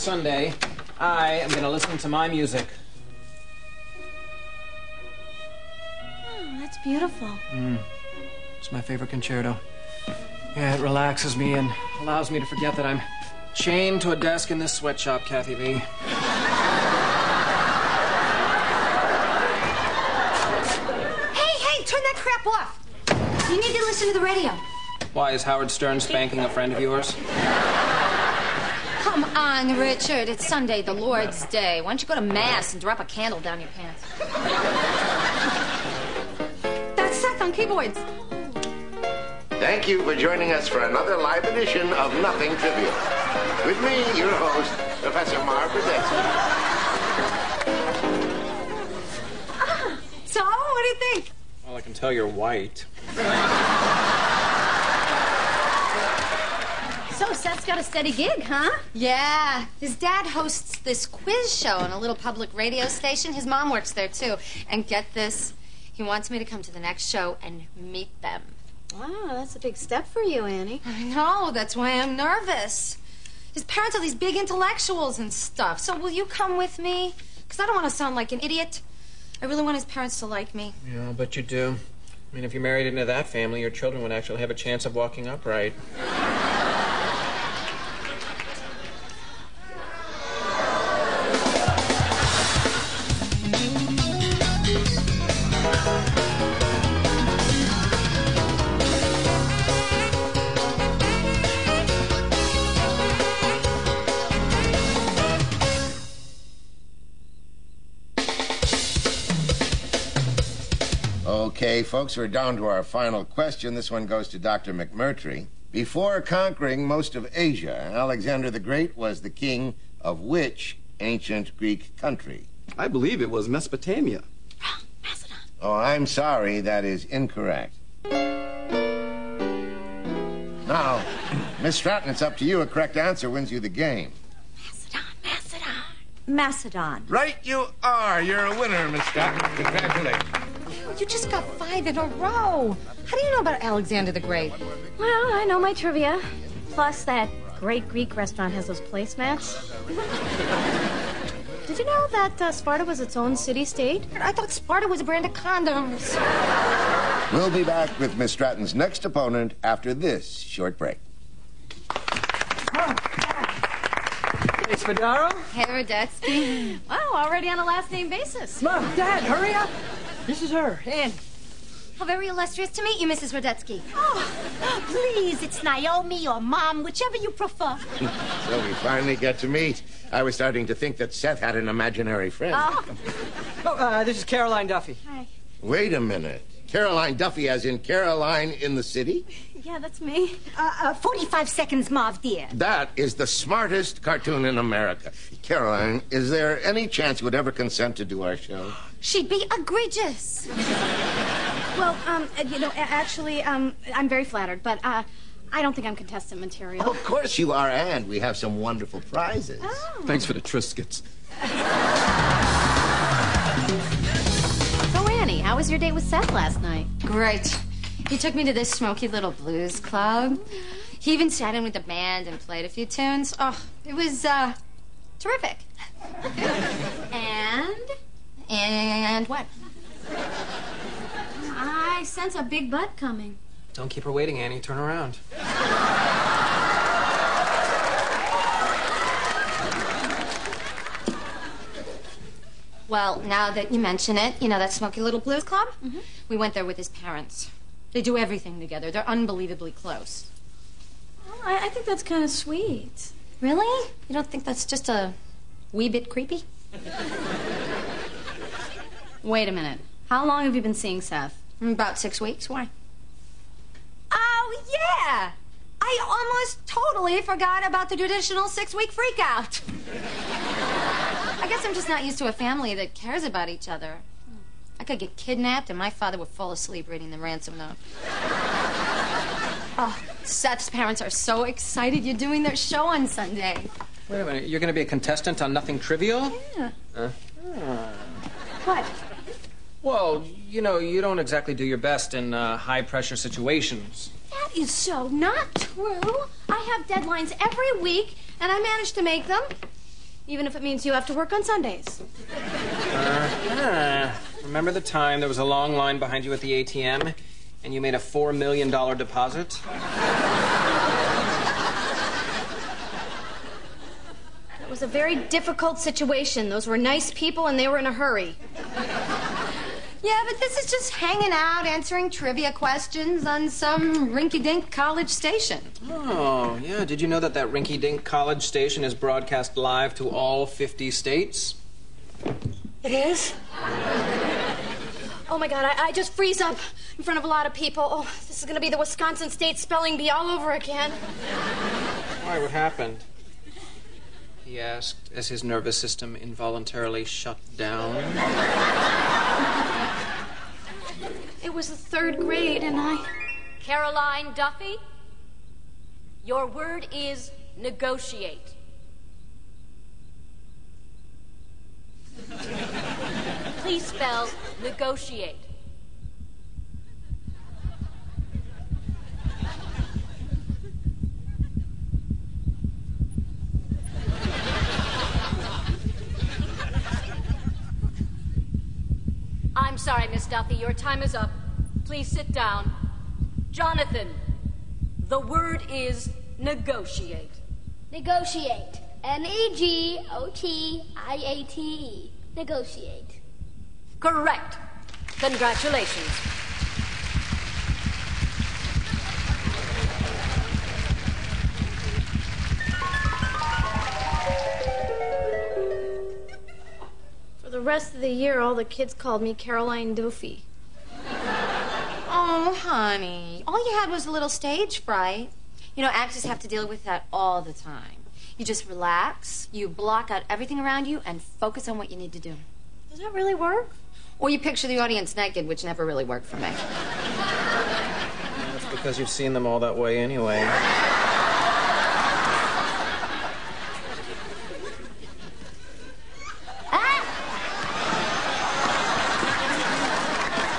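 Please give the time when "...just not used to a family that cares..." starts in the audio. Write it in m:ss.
4:31.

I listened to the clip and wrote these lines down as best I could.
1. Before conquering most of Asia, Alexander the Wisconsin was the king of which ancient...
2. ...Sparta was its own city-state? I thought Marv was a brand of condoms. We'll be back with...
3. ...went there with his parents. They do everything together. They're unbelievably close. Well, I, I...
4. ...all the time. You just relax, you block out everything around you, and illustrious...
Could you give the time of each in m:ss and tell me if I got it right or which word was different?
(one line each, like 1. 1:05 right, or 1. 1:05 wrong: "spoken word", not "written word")
1. 1:55 wrong: "Great", not "Wisconsin"
2. 2:32 wrong: "Sparta", not "Marv"
3. 4:06 right
4. 6:57 wrong: "focus", not "illustrious".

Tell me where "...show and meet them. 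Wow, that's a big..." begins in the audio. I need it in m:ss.
1:07.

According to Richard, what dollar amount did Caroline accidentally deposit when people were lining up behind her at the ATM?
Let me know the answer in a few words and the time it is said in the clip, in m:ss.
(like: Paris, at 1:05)
$4 million, at 5:07.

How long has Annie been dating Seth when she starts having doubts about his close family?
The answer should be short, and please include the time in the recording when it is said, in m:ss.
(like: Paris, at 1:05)
Six weeks, at 4:21.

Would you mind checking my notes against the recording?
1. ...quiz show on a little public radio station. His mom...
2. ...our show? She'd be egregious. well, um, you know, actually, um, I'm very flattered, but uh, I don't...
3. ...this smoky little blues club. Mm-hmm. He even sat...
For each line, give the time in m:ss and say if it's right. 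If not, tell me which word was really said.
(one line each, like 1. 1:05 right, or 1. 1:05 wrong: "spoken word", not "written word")
1. 1:01 right
2. 3:18 right
3. 3:38 right.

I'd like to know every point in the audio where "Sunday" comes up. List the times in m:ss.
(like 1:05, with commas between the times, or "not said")
0:30, 4:43, 5:01.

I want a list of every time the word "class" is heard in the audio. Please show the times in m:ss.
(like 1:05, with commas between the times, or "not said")
not said.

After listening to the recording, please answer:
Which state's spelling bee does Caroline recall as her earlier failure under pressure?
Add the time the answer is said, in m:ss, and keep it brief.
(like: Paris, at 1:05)
Wisconsin, at 5:38.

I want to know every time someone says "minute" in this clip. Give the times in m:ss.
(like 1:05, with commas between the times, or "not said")
3:06, 4:19, 4:44.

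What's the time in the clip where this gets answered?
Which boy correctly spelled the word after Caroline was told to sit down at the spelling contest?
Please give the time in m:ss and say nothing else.
6:23.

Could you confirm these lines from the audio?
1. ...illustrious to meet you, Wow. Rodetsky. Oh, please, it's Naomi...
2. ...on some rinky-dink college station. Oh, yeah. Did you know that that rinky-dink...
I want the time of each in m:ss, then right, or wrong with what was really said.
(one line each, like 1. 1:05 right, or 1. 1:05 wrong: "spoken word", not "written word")
1. 2:52 wrong: "Mrs", not "Wow"
2. 5:23 right.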